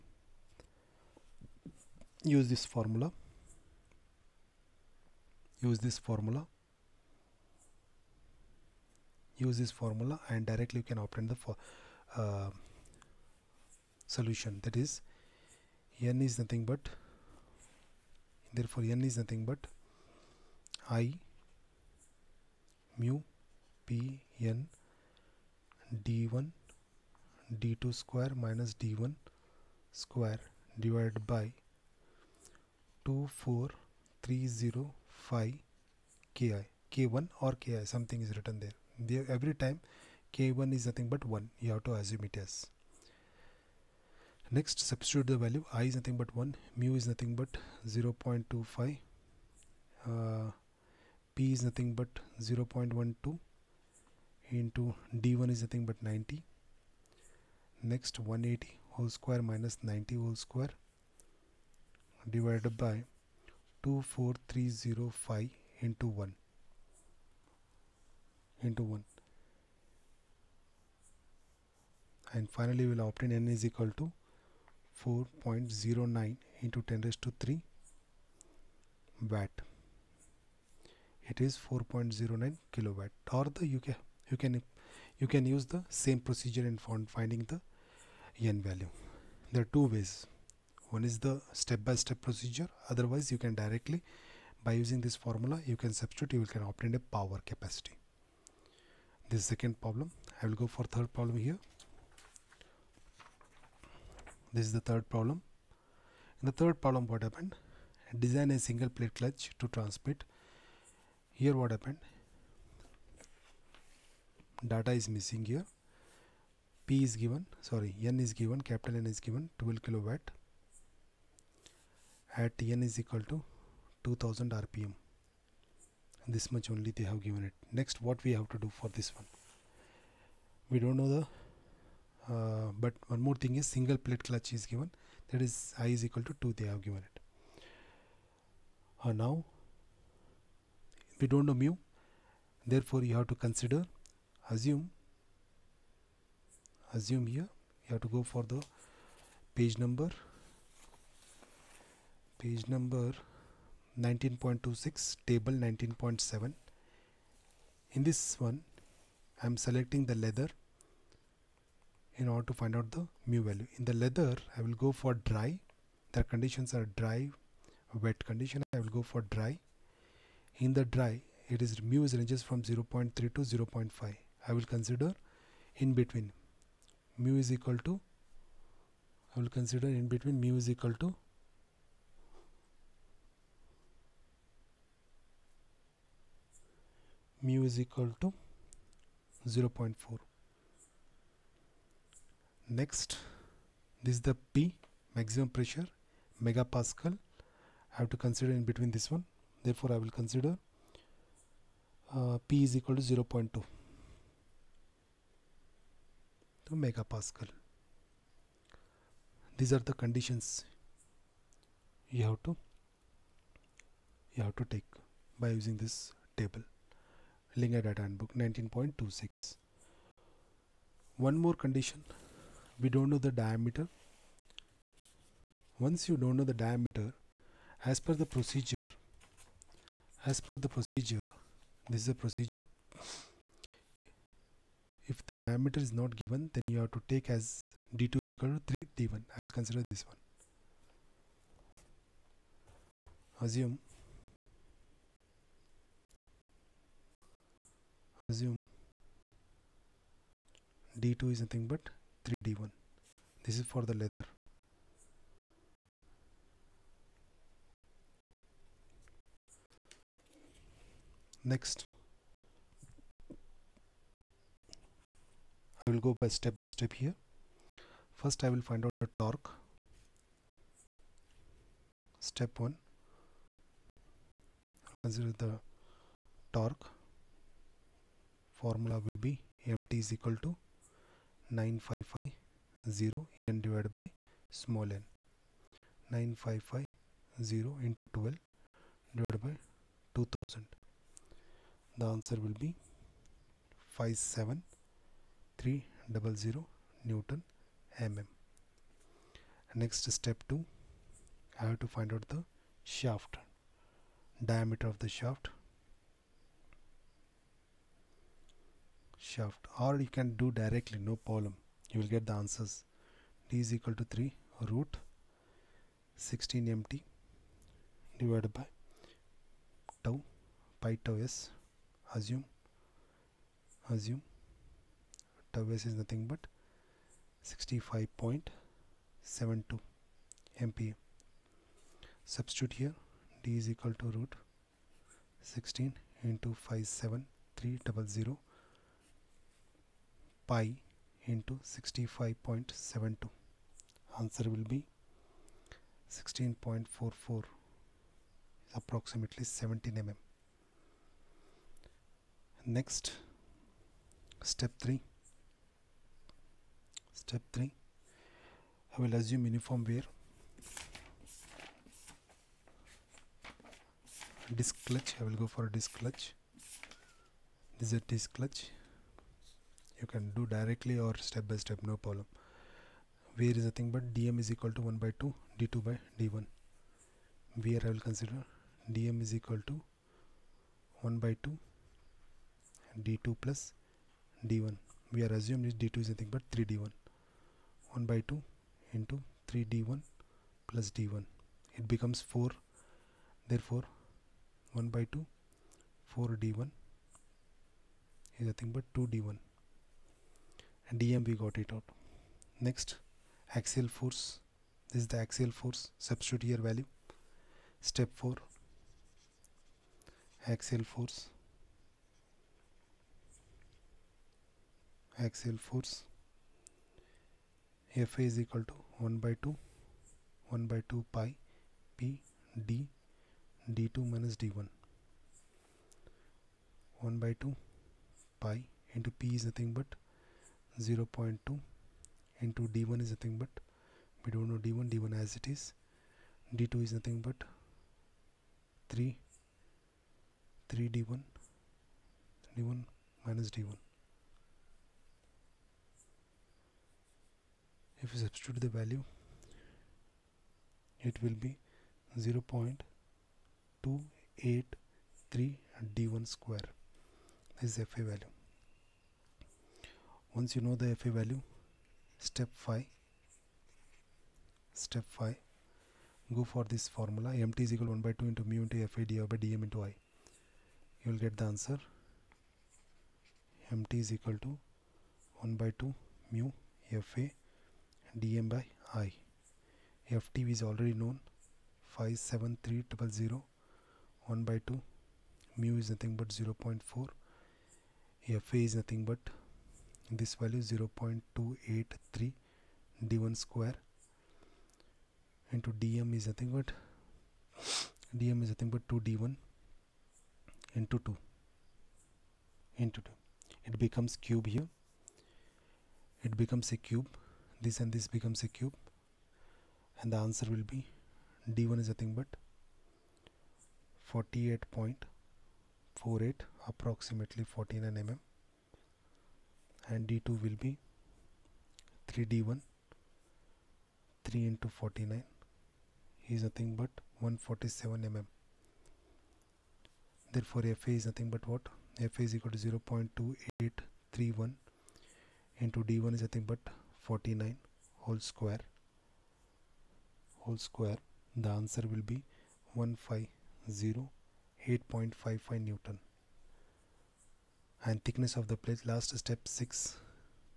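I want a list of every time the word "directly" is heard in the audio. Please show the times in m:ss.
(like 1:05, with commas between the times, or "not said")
0:10, 1:33, 5:10, 6:10.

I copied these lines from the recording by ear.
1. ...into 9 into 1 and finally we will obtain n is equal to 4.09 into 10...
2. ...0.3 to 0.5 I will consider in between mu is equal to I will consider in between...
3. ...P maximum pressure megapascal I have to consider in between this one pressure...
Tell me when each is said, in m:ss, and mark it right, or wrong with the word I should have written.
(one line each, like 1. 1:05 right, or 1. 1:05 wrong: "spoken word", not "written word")
1. 1:05 wrong: "1", not "9"
2. 2:52 right
3. 3:14 wrong: "therefore", not "pressure".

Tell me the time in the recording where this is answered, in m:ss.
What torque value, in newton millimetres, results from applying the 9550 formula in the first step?
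4:54.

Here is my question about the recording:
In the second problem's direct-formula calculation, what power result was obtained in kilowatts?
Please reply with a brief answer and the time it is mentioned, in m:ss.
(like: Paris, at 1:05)
4.09 kilowatt, at 1:21.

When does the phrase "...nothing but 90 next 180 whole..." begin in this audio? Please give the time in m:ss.
0:55.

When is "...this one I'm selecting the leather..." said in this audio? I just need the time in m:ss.
2:38.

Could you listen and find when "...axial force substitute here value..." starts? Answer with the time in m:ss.
6:45.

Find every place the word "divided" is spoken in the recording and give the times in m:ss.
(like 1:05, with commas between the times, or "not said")
0:30, 1:02, 4:43, 4:49, 5:18, 7:49.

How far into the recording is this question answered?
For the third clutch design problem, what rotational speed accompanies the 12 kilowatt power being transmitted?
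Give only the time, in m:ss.
2:04.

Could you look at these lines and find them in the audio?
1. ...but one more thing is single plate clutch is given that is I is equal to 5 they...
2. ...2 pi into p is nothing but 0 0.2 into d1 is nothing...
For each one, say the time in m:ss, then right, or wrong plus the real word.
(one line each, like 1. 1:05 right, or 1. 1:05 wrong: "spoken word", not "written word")
1. 2:12 wrong: "2", not "5"
2. 7:07 right.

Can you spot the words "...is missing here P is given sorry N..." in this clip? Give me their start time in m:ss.
1:54.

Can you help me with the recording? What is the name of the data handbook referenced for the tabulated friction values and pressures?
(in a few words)
Lingaiah.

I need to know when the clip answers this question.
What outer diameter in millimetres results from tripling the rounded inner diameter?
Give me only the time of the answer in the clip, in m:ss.
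8:47.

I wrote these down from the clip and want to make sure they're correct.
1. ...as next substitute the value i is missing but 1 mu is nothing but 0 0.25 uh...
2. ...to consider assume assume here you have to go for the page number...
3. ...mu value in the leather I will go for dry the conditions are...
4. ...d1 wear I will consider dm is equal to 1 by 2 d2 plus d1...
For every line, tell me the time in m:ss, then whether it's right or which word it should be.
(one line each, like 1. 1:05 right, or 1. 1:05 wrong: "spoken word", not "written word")
1. 0:42 wrong: "nothing", not "missing"
2. 2:23 right
3. 2:43 right
4. 6:16 right.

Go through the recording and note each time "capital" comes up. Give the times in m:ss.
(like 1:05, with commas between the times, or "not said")
1:58.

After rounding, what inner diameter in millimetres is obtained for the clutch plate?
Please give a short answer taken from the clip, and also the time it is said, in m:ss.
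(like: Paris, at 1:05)
49 mm, at 8:36.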